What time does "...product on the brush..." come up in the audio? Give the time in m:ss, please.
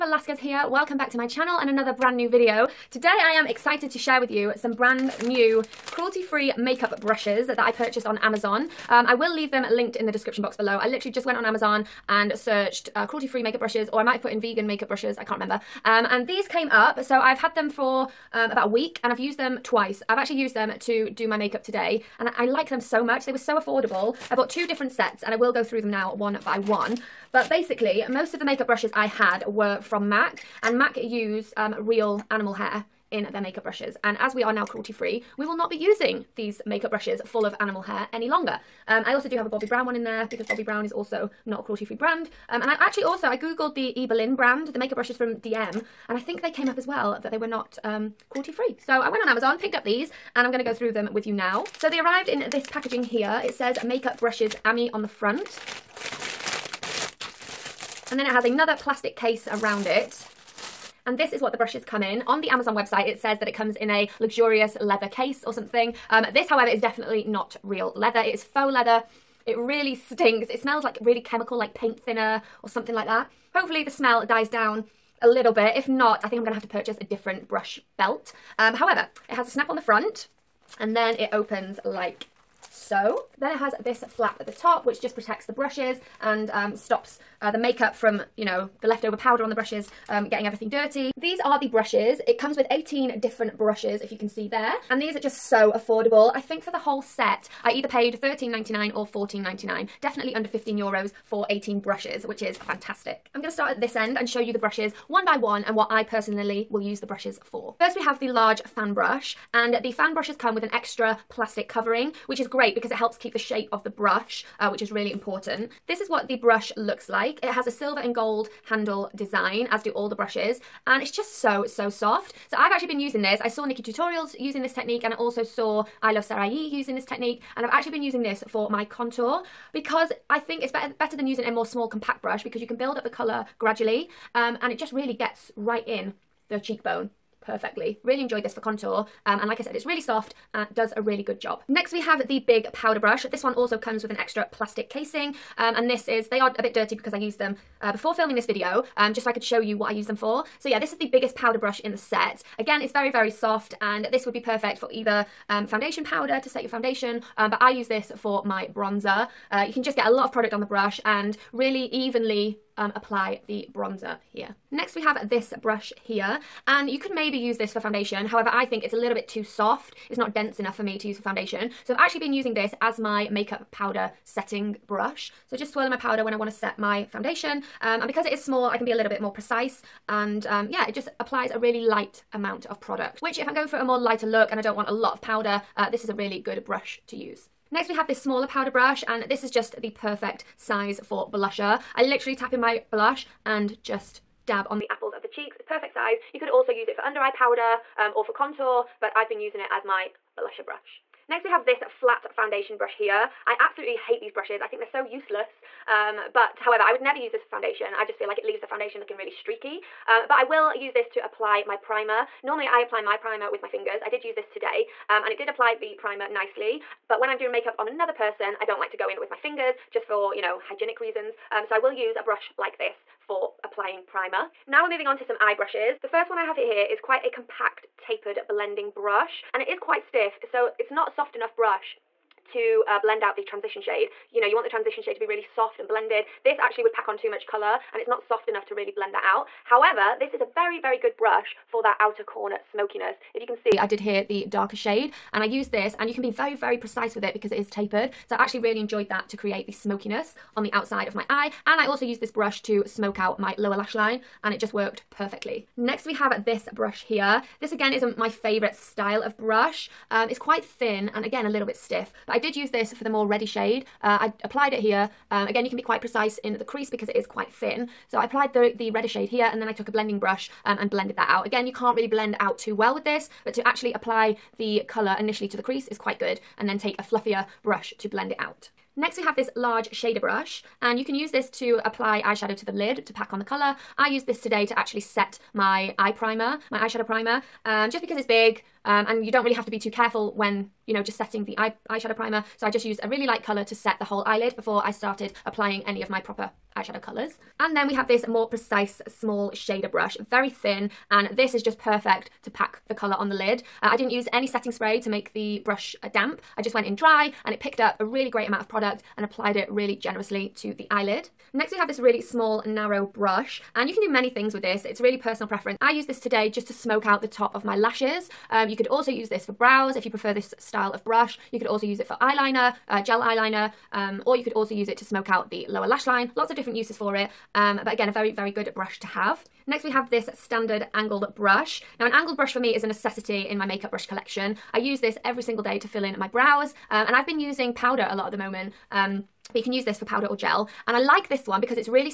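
2:40.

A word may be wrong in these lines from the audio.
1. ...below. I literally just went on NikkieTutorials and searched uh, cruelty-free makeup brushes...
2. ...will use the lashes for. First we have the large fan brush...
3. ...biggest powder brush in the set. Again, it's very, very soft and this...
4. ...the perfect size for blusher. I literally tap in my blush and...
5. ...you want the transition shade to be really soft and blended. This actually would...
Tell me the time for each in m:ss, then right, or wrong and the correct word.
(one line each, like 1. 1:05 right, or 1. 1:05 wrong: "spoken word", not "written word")
1. 0:10 wrong: "Amazon", not "NikkieTutorials"
2. 1:46 wrong: "brushes", not "lashes"
3. 2:31 right
4. 3:09 right
5. 3:54 right.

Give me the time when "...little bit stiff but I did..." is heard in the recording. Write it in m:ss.
4:21.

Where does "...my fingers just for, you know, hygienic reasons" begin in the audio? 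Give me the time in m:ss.
3:39.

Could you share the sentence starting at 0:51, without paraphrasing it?
So they arrived in this packaging here.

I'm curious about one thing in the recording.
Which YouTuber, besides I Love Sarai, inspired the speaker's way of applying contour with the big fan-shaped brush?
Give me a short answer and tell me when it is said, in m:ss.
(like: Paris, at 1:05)
NikkieTutorials, at 2:03.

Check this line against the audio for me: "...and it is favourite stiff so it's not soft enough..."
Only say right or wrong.
wrong.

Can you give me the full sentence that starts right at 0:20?
I've actually used them to do my makeup today and I like them so much.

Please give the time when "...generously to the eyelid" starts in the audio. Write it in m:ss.
5:09.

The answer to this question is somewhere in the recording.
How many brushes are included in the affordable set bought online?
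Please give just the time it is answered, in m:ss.
1:32.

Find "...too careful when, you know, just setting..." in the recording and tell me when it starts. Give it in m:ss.
4:49.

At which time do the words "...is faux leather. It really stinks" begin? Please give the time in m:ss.
1:08.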